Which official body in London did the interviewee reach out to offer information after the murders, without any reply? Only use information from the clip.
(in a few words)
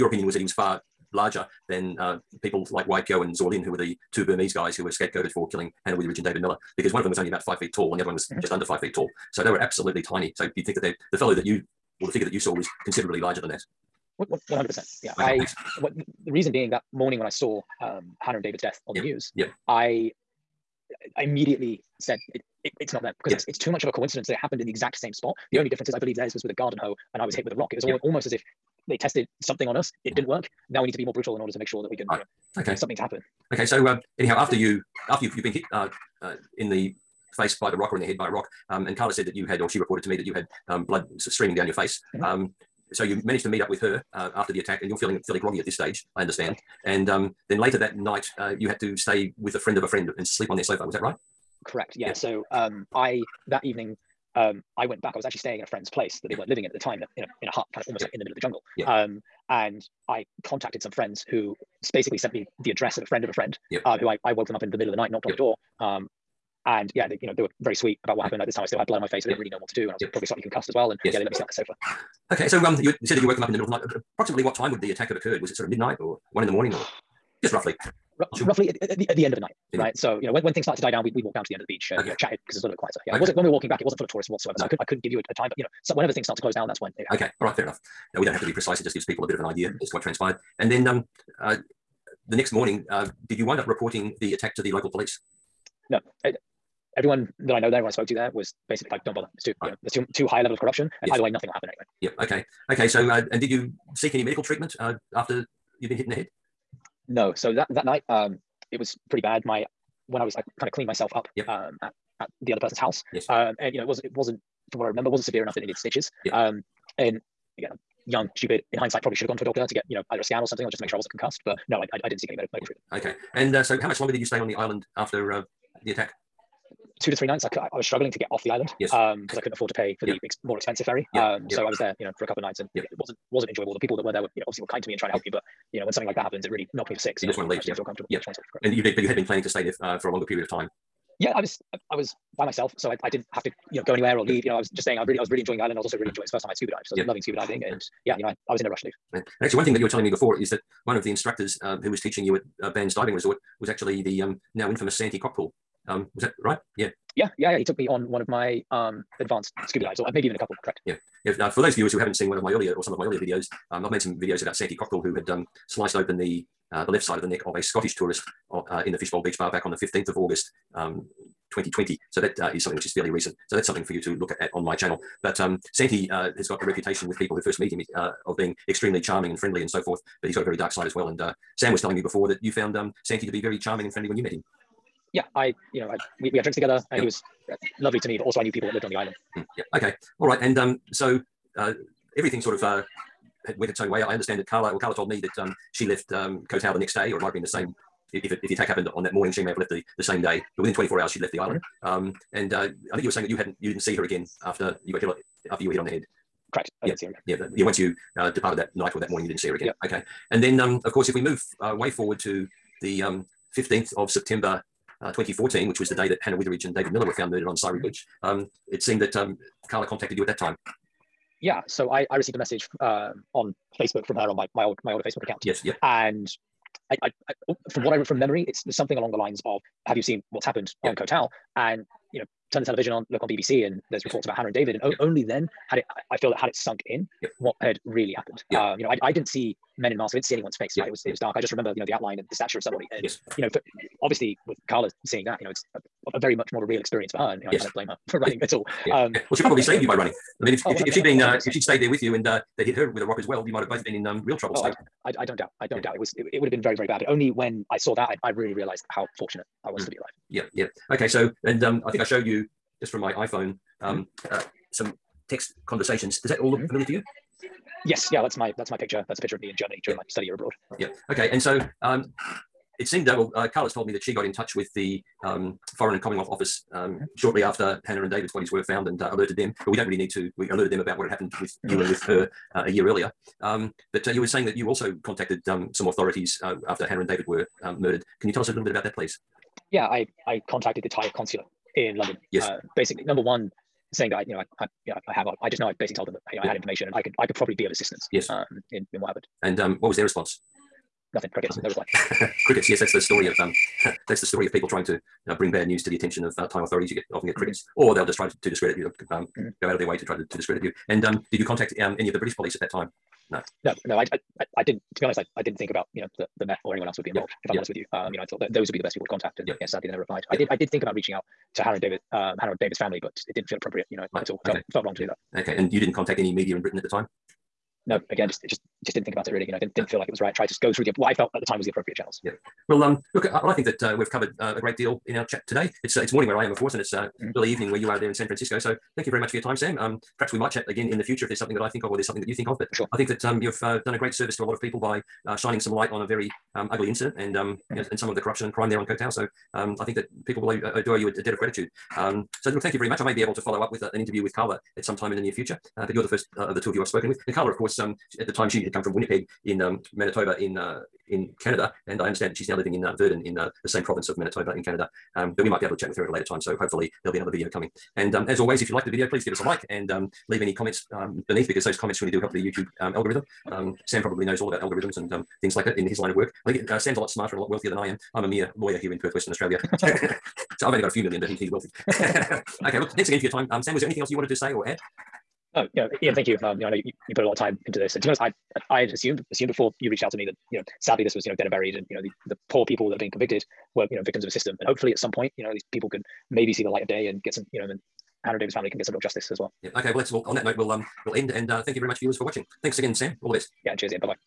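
Thai consulate.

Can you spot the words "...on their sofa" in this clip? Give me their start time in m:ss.
0:50.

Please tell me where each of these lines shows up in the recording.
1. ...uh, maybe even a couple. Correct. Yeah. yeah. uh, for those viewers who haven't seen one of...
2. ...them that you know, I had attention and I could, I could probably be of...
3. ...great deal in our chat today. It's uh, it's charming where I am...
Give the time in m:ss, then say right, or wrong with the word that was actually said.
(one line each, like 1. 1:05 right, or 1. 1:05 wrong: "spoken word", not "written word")
1. 2:40 right
2. 4:56 wrong: "information", not "attention"
3. 5:34 wrong: "morning", not "charming".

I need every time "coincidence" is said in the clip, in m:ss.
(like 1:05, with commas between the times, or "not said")
0:23.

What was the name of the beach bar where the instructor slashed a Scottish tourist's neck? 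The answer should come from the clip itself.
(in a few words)
Fishbowl Beach Bar.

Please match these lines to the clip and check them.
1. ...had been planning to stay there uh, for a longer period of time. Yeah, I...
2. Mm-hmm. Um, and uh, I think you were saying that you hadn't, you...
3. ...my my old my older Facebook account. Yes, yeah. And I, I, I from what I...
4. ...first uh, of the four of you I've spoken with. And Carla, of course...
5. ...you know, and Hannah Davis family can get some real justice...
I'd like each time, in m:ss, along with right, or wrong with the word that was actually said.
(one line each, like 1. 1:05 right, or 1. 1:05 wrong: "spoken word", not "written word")
1. 2:19 right
2. 3:21 right
3. 3:44 right
4. 5:56 wrong: "two", not "four"
5. 6:37 right.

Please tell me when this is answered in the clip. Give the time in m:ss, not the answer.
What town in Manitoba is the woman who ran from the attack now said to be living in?
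6:02.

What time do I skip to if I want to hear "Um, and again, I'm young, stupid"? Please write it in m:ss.
1:56.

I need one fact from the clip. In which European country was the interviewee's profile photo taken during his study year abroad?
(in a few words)
Germany.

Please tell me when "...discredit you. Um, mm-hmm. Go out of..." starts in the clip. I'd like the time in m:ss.
5:08.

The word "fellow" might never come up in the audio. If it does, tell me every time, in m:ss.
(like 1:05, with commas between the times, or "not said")
0:11.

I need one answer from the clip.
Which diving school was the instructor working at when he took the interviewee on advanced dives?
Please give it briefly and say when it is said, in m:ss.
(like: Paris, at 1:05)
Ban's Diving Resort, at 2:32.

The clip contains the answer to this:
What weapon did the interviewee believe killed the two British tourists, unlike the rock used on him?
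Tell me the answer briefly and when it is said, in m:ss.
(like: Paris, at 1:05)
Garden hoe, at 0:26.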